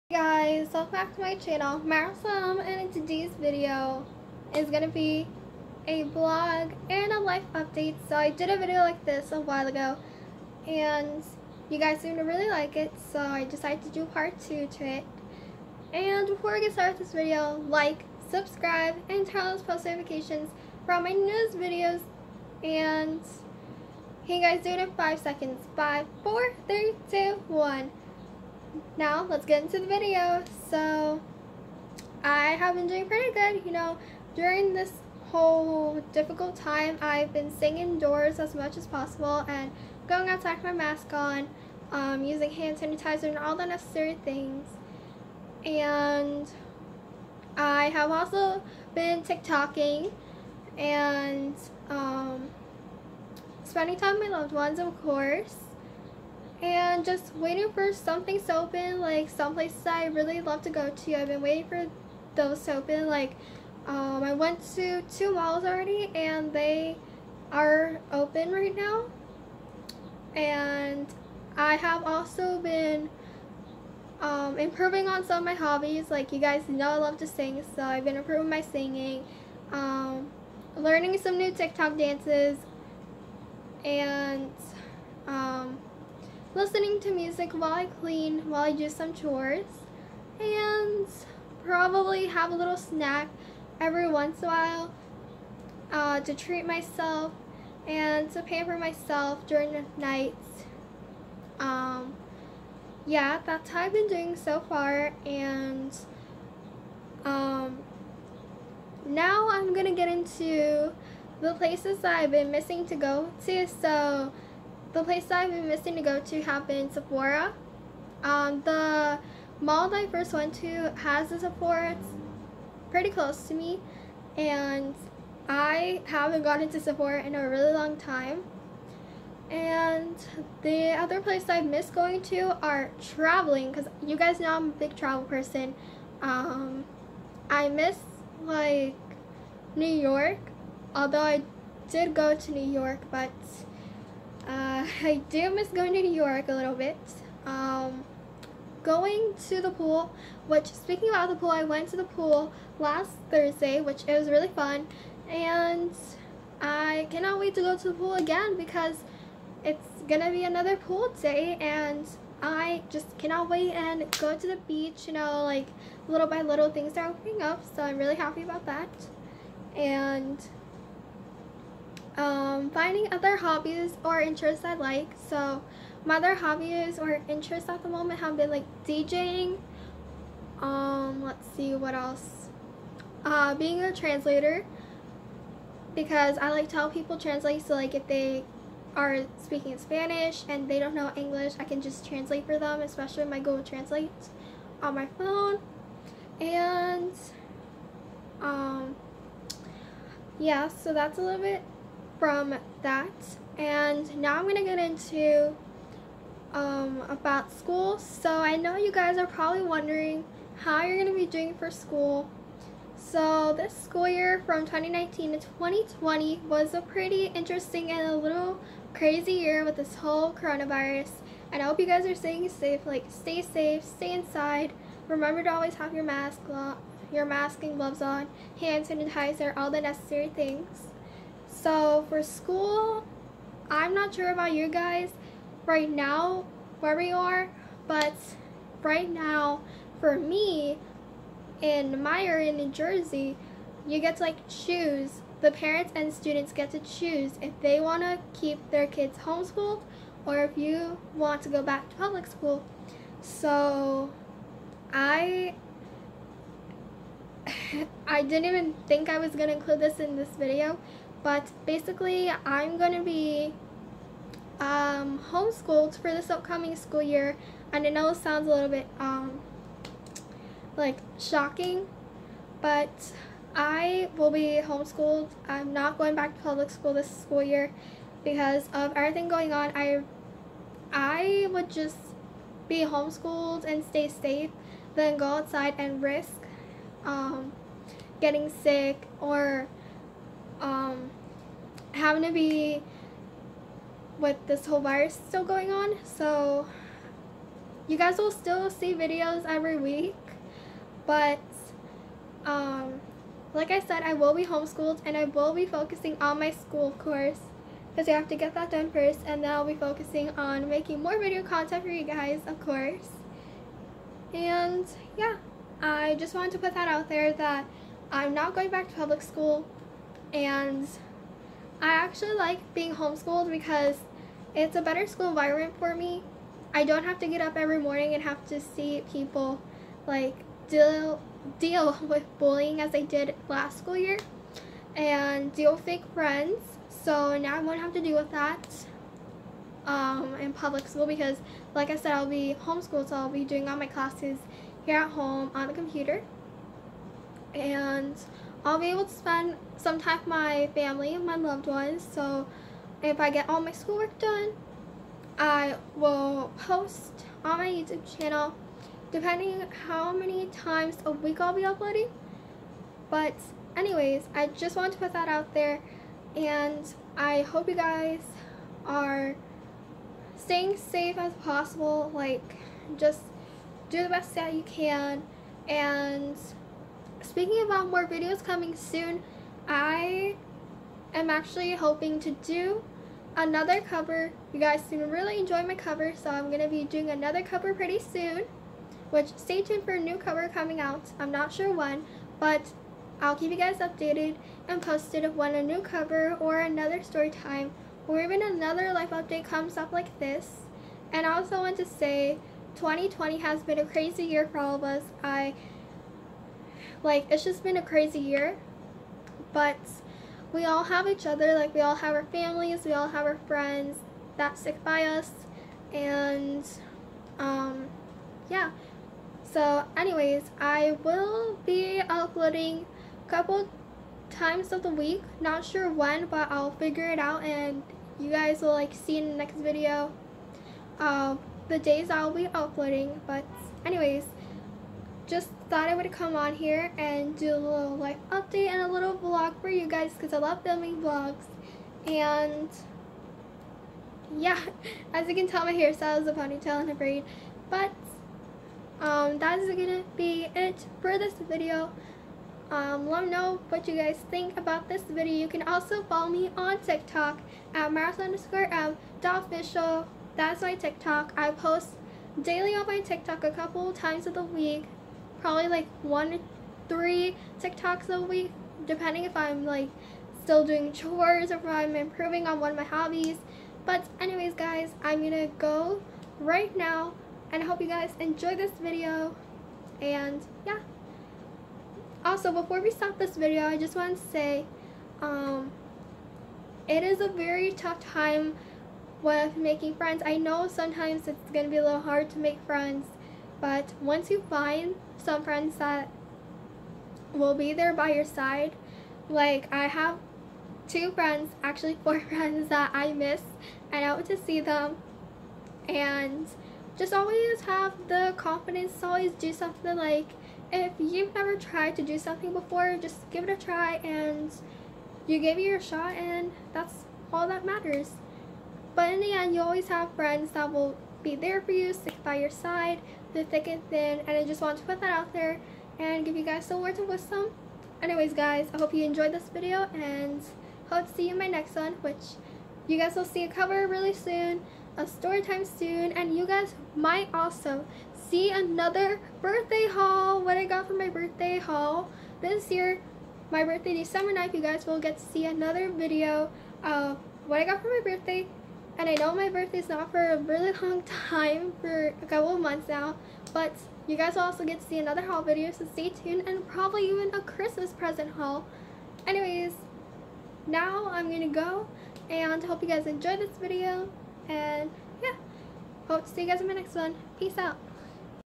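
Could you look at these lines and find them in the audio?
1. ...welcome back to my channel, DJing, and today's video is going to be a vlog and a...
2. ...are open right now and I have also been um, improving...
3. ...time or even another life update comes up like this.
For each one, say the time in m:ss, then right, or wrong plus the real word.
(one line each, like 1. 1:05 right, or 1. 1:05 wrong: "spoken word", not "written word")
1. 0:00 wrong: "Marisol", not "DJing"
2. 1:07 right
3. 6:37 right.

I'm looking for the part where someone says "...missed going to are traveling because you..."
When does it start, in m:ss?
2:11.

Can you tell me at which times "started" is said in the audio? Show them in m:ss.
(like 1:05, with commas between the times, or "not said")
0:16.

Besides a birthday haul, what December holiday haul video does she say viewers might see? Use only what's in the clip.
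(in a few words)
Christmas present haul.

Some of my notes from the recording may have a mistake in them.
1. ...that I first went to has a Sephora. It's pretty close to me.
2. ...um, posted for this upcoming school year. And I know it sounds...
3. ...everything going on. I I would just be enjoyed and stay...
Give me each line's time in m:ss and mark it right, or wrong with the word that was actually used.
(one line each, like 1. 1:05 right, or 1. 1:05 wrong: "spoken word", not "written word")
1. 1:59 right
2. 4:24 wrong: "homeschooled", not "posted"
3. 4:38 wrong: "homeschooled", not "enjoyed".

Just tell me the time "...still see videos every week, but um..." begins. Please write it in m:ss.
4:58.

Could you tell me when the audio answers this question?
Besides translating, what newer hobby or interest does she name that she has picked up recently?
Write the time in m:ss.
2:58.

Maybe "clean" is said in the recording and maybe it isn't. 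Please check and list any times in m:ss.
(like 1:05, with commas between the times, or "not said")
1:27.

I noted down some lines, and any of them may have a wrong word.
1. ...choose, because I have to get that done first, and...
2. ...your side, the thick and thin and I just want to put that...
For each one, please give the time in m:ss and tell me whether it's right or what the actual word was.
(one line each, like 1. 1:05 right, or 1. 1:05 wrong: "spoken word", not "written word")
1. 5:06 wrong: "course", not "choose"
2. 8:42 right.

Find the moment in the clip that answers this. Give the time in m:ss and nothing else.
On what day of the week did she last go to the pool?
2:32.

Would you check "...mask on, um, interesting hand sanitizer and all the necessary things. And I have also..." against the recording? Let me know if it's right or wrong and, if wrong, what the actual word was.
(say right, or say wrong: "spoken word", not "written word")
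wrong: "using", not "interesting".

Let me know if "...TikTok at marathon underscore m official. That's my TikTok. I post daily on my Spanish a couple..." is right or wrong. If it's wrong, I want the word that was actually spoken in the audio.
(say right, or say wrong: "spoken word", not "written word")
wrong: "TikTok", not "Spanish".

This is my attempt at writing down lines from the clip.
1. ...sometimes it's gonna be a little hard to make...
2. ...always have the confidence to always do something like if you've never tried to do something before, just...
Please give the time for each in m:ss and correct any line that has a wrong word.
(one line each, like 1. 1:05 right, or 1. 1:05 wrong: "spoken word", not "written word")
1. 8:10 right
2. 8:27 right.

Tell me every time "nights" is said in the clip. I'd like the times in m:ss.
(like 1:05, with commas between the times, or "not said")
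1:39, 9:04.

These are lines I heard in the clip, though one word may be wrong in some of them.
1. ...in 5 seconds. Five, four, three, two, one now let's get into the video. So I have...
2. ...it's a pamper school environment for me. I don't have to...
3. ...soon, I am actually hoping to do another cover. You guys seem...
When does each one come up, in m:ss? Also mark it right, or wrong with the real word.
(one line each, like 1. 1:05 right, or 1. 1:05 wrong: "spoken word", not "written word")
1. 0:24 right
2. 5:24 wrong: "better", not "pamper"
3. 6:18 right.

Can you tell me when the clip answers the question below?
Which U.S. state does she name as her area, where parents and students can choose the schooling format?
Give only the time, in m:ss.
4:02.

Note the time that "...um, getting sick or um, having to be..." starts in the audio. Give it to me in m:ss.
4:47.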